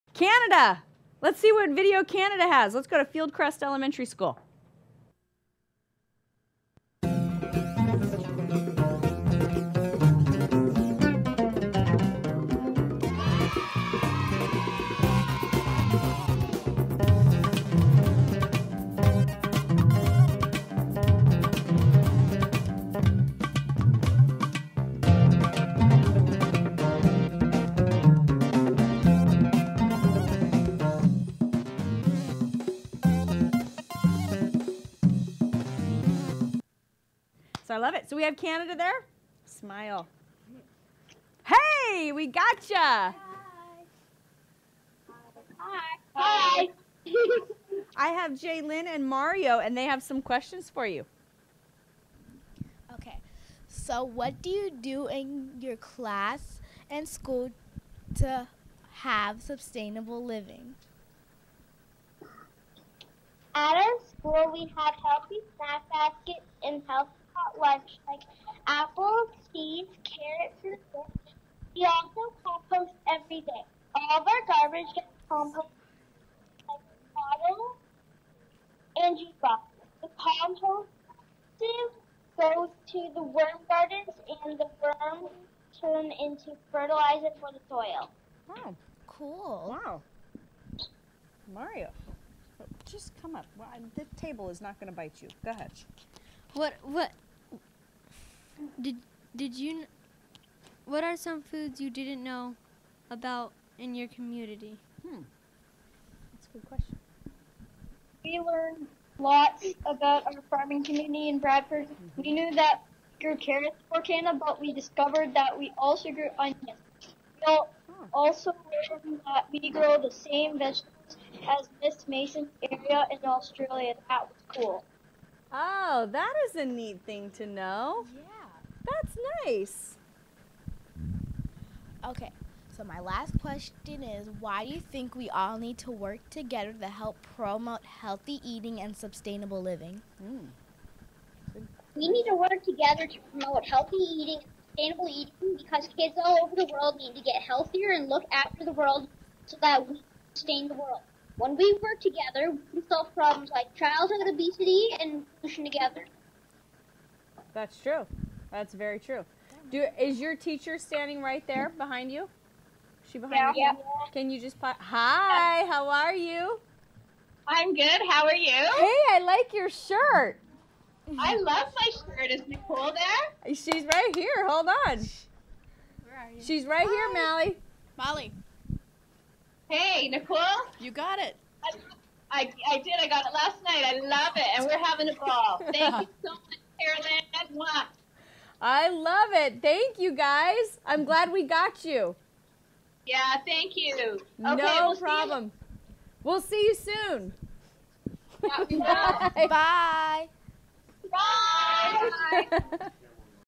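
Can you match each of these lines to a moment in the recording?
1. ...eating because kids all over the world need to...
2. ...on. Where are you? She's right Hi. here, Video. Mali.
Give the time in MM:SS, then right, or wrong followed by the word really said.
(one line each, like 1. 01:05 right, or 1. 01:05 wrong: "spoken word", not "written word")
1. 02:25 right
2. 02:54 wrong: "Mali", not "Video".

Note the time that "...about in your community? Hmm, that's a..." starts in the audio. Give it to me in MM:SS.
01:43.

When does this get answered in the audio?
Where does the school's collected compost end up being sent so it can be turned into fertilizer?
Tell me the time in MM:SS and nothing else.
01:23.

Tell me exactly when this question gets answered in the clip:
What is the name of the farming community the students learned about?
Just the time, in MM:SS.
01:51.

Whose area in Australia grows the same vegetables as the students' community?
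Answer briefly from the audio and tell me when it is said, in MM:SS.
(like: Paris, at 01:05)
Miss Mason's, at 02:01.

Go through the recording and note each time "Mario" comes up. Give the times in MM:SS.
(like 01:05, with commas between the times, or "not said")
00:49, 01:31.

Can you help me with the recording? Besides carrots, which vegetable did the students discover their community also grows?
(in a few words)
onions.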